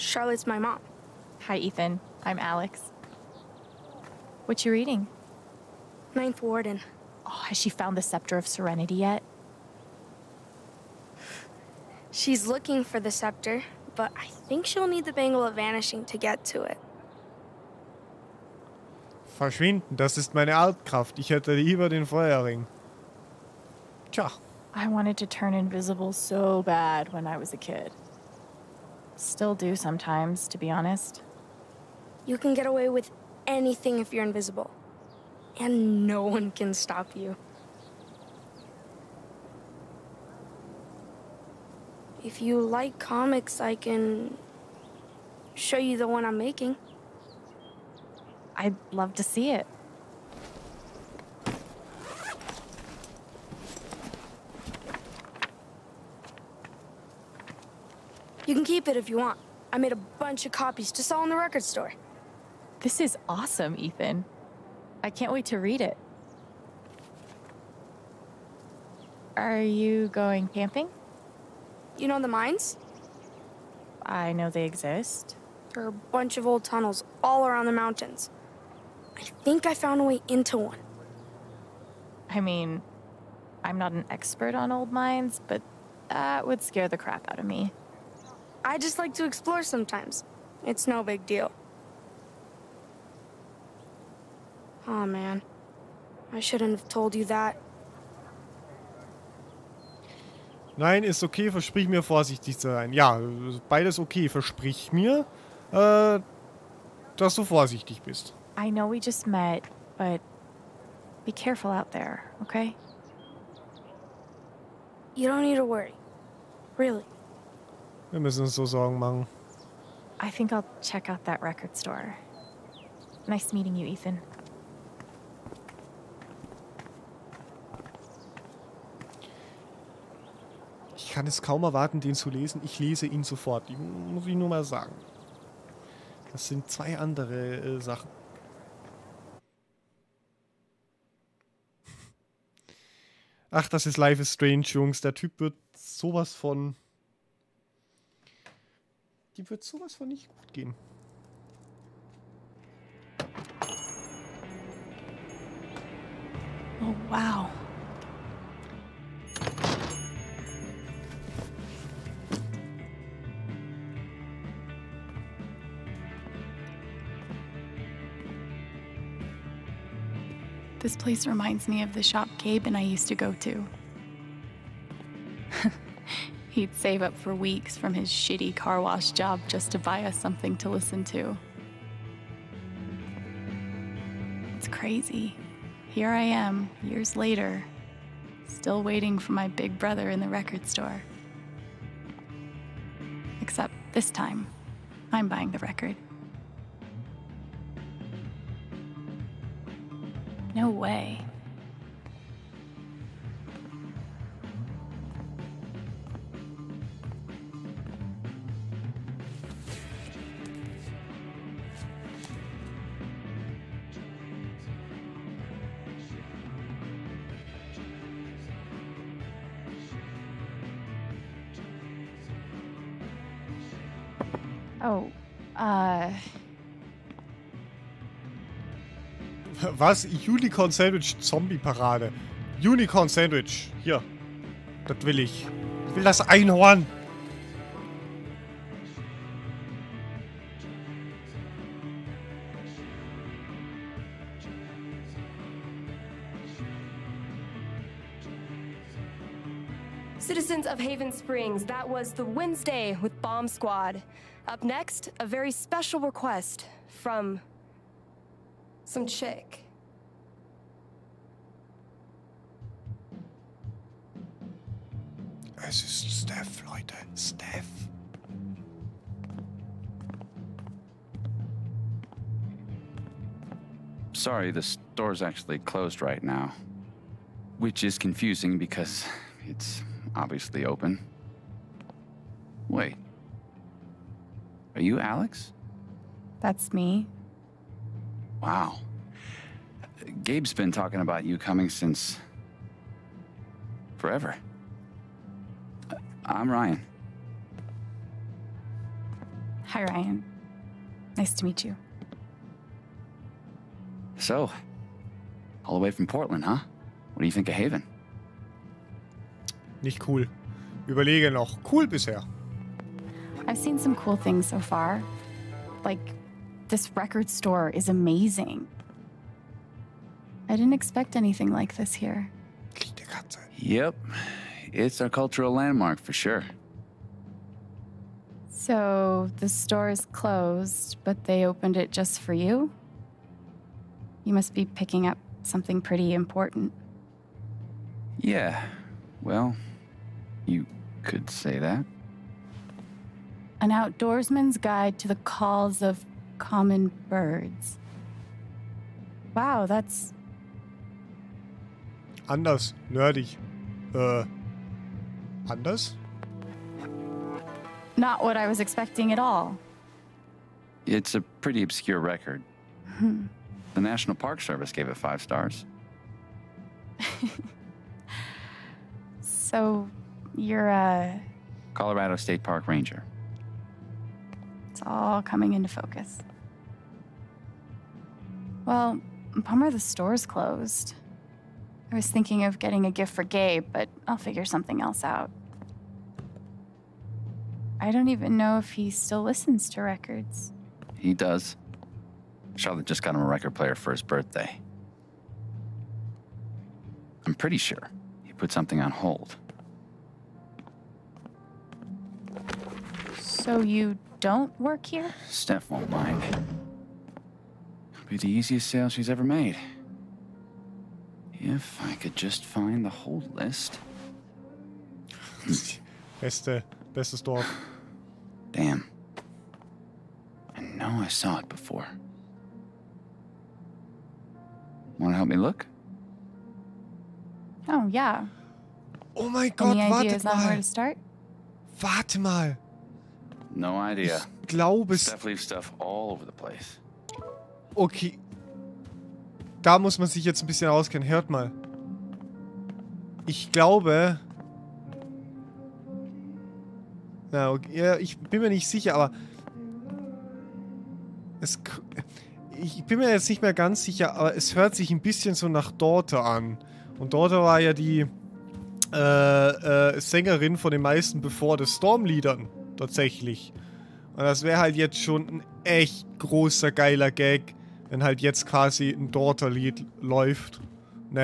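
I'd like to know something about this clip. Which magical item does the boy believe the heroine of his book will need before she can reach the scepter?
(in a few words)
Bangle of Vanishing.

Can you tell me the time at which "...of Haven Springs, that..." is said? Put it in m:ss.
4:10.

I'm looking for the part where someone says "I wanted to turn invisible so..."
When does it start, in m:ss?
0:24.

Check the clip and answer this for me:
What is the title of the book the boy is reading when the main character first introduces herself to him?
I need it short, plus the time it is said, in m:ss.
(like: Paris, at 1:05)
Ninth Warden, at 0:06.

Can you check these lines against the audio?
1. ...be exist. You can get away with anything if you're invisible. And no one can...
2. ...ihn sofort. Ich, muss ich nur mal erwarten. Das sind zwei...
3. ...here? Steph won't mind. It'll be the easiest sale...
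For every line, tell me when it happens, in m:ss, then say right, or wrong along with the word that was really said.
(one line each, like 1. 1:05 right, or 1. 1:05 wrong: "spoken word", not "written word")
1. 0:30 wrong: "honest", not "exist"
2. 2:13 wrong: "sagen", not "erwarten"
3. 6:44 right.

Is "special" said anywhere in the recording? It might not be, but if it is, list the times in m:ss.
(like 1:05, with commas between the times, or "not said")
4:15.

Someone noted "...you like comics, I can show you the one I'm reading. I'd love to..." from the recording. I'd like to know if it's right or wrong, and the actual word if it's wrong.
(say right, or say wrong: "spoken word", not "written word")
wrong: "making", not "reading".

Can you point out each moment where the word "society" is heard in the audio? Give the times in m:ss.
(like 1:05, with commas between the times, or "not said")
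not said.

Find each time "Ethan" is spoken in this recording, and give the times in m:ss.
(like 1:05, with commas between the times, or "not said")
0:01, 1:03, 2:03.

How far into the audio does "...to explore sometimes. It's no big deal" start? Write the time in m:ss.
1:29.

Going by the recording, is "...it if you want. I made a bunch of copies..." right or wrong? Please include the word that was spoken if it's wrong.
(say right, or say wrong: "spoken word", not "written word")
right.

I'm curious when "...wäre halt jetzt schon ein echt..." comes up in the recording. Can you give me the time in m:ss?
7:44.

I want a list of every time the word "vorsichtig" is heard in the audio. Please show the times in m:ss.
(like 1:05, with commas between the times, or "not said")
1:42, 1:47.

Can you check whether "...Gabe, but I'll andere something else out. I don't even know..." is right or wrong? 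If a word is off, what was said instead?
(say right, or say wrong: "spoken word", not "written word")
wrong: "figure", not "andere".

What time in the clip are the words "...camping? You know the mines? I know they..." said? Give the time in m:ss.
1:10.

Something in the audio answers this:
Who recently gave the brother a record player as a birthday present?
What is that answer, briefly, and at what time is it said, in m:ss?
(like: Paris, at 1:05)
Charlotte, at 6:32.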